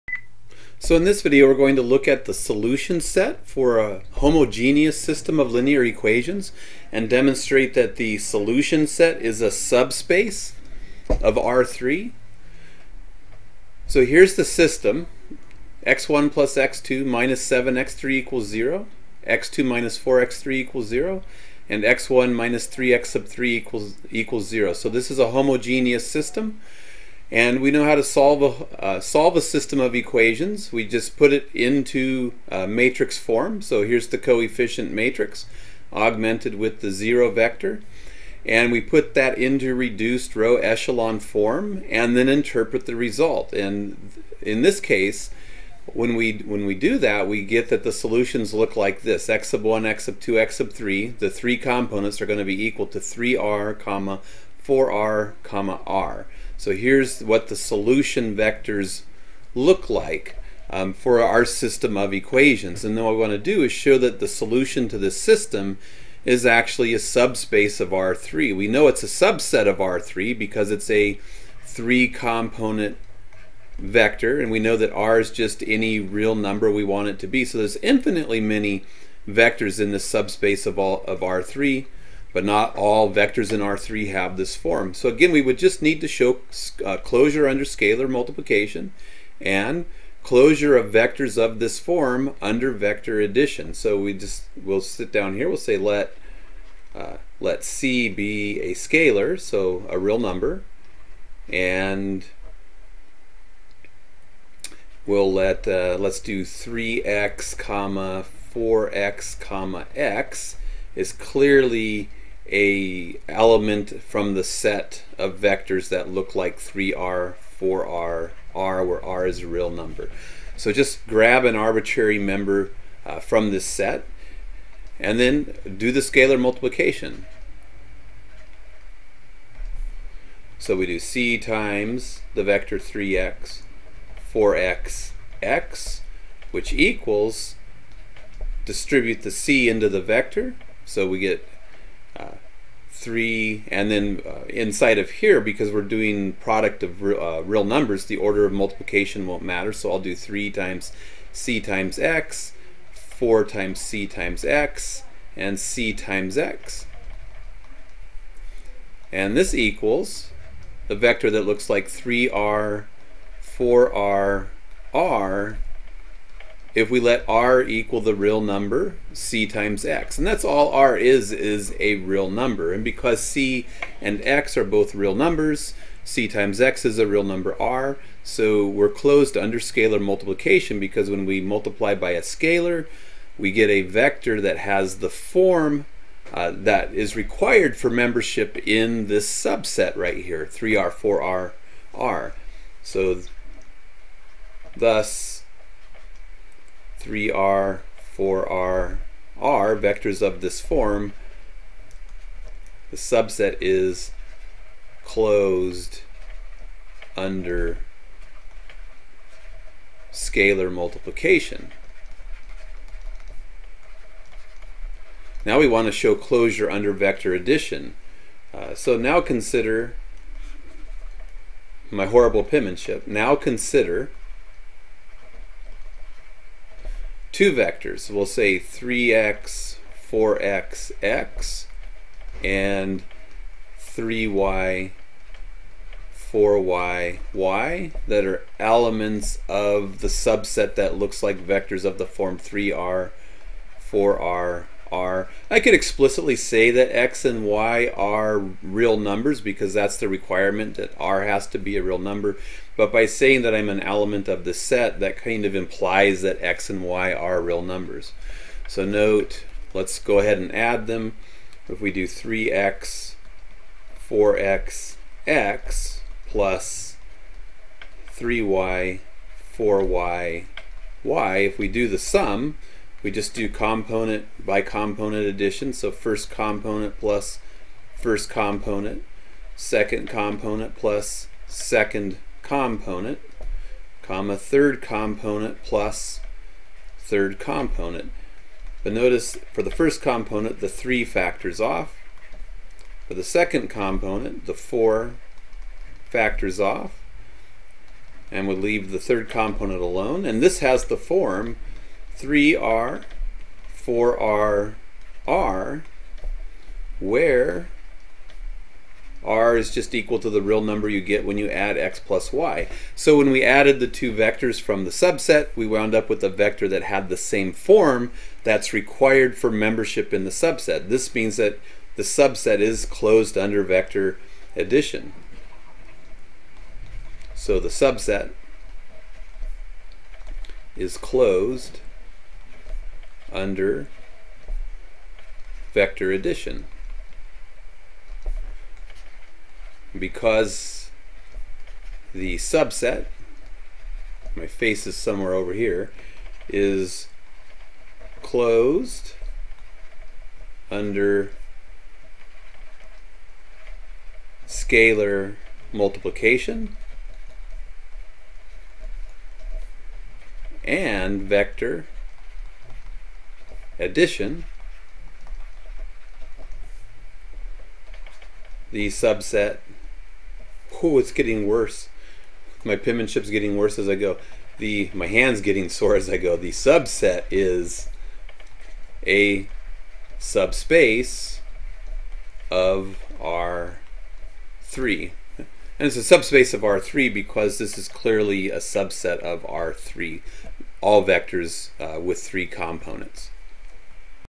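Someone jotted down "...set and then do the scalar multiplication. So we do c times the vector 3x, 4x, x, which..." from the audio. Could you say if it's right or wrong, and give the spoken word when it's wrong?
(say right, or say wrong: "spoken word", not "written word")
right.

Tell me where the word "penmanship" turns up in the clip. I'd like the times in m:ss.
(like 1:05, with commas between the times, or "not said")
3:42, 6:12.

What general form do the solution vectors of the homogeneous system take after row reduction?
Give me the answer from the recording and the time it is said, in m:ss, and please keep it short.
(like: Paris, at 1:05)
3r, 4r, r, at 0:52.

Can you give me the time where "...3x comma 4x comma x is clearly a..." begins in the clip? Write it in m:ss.
1:46.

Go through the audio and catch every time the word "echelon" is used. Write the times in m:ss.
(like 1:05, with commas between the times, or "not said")
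0:40.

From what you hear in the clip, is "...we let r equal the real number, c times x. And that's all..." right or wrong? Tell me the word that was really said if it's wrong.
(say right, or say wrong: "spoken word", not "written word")
right.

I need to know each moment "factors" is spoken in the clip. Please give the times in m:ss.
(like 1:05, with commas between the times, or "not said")
4:51, 4:56.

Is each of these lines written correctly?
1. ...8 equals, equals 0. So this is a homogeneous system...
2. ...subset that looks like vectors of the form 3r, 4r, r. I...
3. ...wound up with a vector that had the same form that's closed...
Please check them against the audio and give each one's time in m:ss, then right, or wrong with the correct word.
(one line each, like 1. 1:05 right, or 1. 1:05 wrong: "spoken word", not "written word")
1. 0:23 wrong: "3", not "8"
2. 4:00 right
3. 5:15 wrong: "required", not "closed".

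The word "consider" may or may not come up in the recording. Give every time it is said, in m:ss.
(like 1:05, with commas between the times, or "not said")
3:39, 3:43.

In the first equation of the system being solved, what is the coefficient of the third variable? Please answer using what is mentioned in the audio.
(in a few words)
-7.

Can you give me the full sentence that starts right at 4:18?
So note, let's go ahead and add them.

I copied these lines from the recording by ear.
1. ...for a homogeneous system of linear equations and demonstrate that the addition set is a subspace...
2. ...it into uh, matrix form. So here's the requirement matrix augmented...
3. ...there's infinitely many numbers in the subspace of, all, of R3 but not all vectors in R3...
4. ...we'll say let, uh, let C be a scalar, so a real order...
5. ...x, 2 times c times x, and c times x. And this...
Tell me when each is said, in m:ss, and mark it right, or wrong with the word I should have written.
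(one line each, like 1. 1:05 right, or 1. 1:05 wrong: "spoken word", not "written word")
1. 0:03 wrong: "solution", not "addition"
2. 0:31 wrong: "coefficient", not "requirement"
3. 1:17 wrong: "vectors", not "numbers"
4. 1:35 wrong: "number", not "order"
5. 2:31 wrong: "4", not "2".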